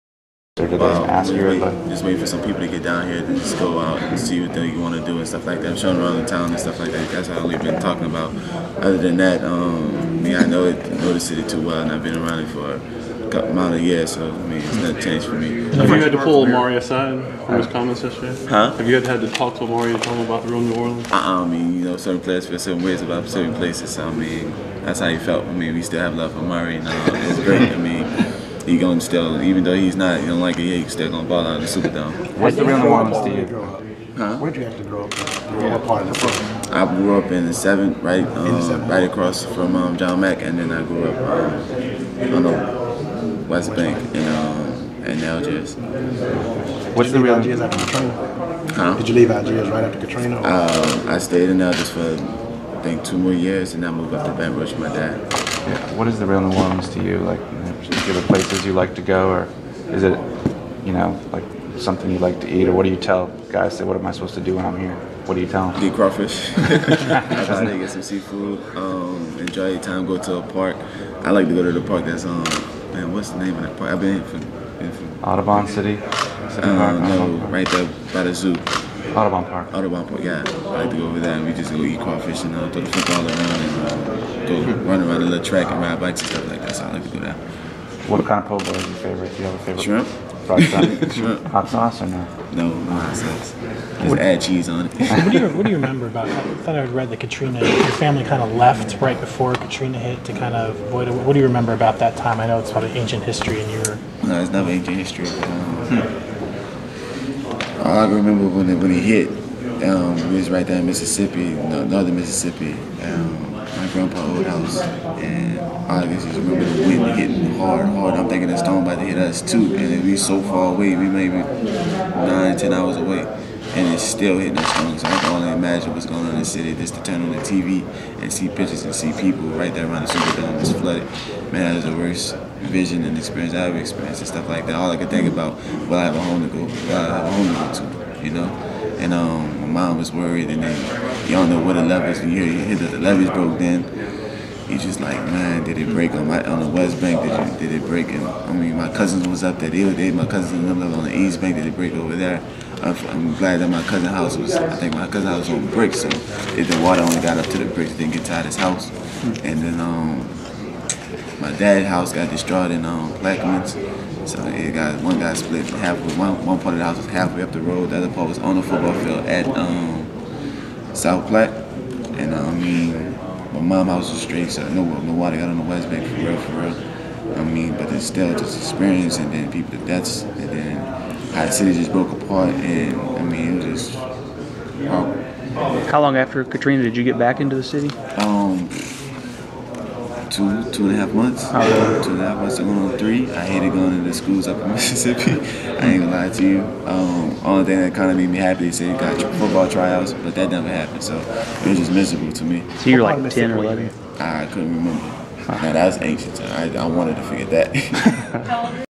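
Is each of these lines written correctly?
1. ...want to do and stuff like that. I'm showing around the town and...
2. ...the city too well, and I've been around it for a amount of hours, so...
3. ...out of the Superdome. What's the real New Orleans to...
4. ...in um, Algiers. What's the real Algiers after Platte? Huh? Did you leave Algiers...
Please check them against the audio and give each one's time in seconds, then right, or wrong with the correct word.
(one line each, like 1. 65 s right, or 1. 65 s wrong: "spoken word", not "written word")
1. 4 s right
2. 11 s wrong: "years", not "hours"
3. 31 s right
4. 44 s wrong: "Katrina", not "Platte".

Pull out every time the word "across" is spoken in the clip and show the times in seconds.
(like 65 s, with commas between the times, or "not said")
39 s.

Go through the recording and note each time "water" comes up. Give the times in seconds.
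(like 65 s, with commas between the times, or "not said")
156 s, 175 s.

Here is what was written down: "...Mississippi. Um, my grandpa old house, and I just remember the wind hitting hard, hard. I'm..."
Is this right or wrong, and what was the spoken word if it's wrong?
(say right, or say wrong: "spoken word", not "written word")
right.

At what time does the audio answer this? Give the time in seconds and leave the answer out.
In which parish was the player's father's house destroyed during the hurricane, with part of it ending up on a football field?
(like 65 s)
163 s.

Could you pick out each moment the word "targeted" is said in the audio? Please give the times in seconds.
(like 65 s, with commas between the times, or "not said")
not said.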